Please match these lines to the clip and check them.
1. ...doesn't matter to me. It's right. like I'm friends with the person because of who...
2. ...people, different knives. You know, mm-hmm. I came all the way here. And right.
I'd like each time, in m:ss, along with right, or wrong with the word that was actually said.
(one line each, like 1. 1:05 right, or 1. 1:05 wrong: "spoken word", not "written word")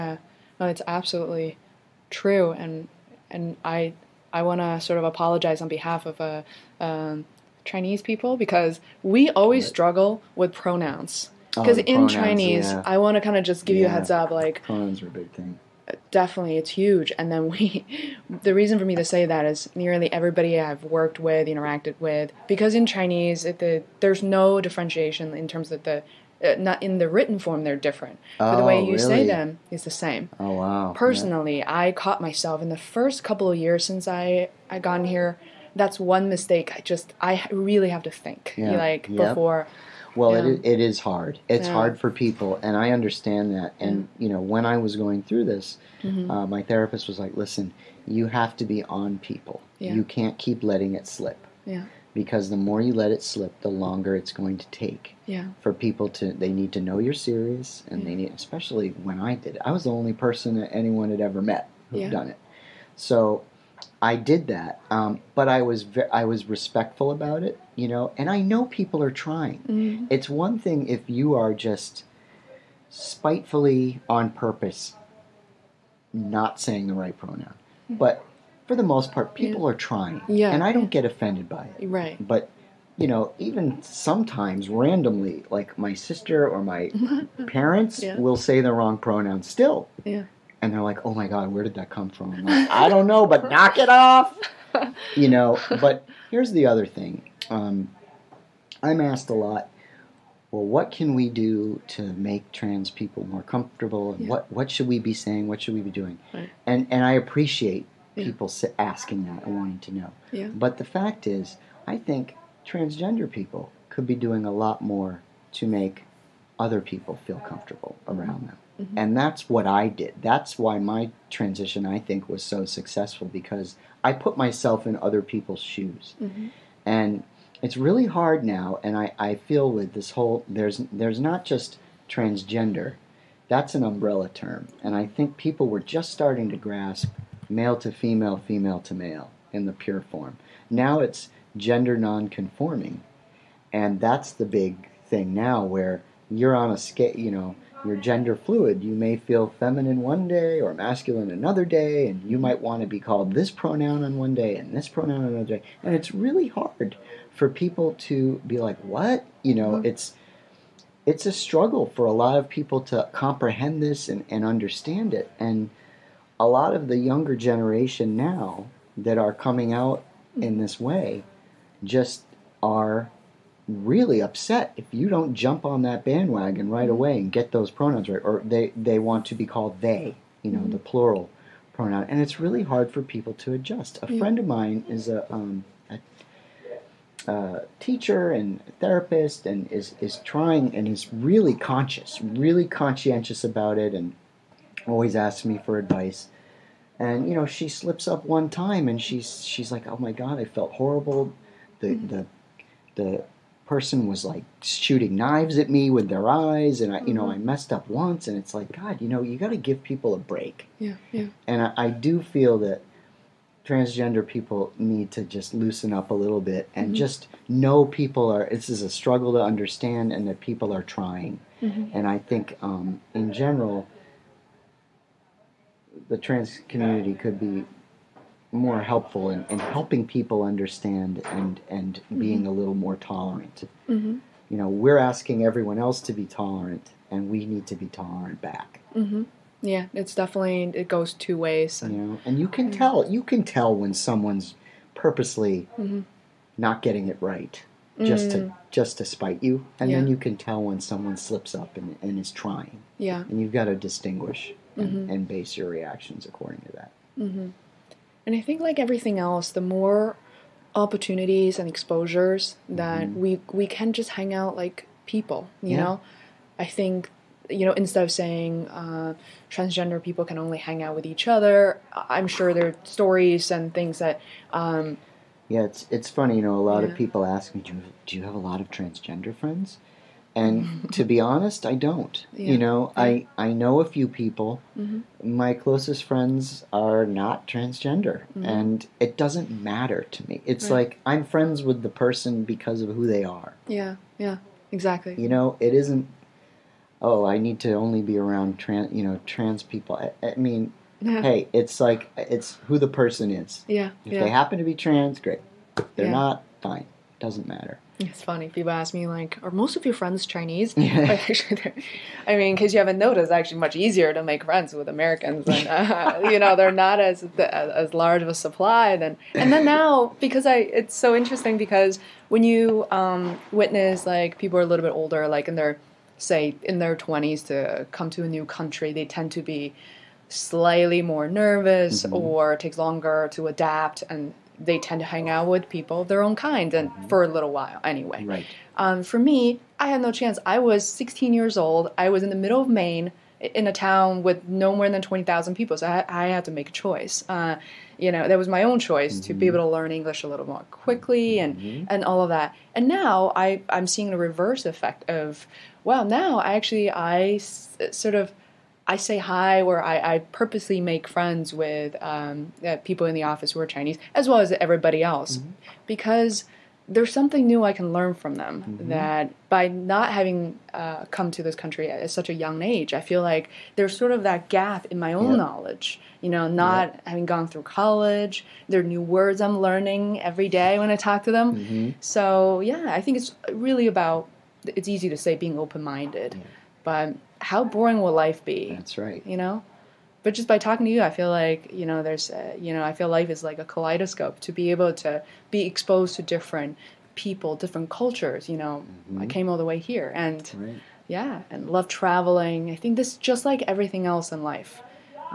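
1. 4:49 right
2. 6:37 wrong: "cultures", not "knives".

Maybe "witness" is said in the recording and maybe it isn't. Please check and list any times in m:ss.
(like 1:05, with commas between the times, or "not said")
5:23.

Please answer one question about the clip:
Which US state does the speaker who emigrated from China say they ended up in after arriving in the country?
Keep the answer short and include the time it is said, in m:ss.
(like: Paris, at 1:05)
Maine, at 5:42.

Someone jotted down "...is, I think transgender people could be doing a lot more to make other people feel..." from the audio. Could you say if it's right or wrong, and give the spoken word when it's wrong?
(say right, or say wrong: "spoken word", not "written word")
right.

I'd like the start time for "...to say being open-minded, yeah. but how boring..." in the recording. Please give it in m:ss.
6:25.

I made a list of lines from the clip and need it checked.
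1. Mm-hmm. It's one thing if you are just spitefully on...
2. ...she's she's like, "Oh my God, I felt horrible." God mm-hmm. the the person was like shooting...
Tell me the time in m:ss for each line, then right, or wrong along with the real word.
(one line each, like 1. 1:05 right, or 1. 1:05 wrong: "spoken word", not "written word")
1. 1:09 right
2. 3:19 wrong: "The", not "God".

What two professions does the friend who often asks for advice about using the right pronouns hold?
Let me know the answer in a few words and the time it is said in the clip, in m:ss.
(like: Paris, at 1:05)
teacher and therapist, at 3:07.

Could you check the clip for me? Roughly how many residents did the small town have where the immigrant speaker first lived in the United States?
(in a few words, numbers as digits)
20,000.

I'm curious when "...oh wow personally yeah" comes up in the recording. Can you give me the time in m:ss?
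0:30.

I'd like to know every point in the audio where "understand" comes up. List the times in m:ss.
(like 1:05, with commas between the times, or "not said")
0:42, 2:44, 3:39, 3:50.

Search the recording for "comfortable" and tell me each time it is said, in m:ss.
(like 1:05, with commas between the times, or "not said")
1:43, 1:57.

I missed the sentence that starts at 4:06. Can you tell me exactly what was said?
not getting it right just to mm.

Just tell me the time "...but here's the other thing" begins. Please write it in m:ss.
1:35.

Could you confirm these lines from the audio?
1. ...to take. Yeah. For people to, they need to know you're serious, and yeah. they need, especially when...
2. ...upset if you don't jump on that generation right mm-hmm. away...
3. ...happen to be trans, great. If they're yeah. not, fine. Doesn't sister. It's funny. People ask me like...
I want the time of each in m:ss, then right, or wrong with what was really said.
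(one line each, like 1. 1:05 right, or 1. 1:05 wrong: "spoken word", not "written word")
1. 0:54 right
2. 2:54 wrong: "bandwagon", not "generation"
3. 5:04 wrong: "matter", not "sister".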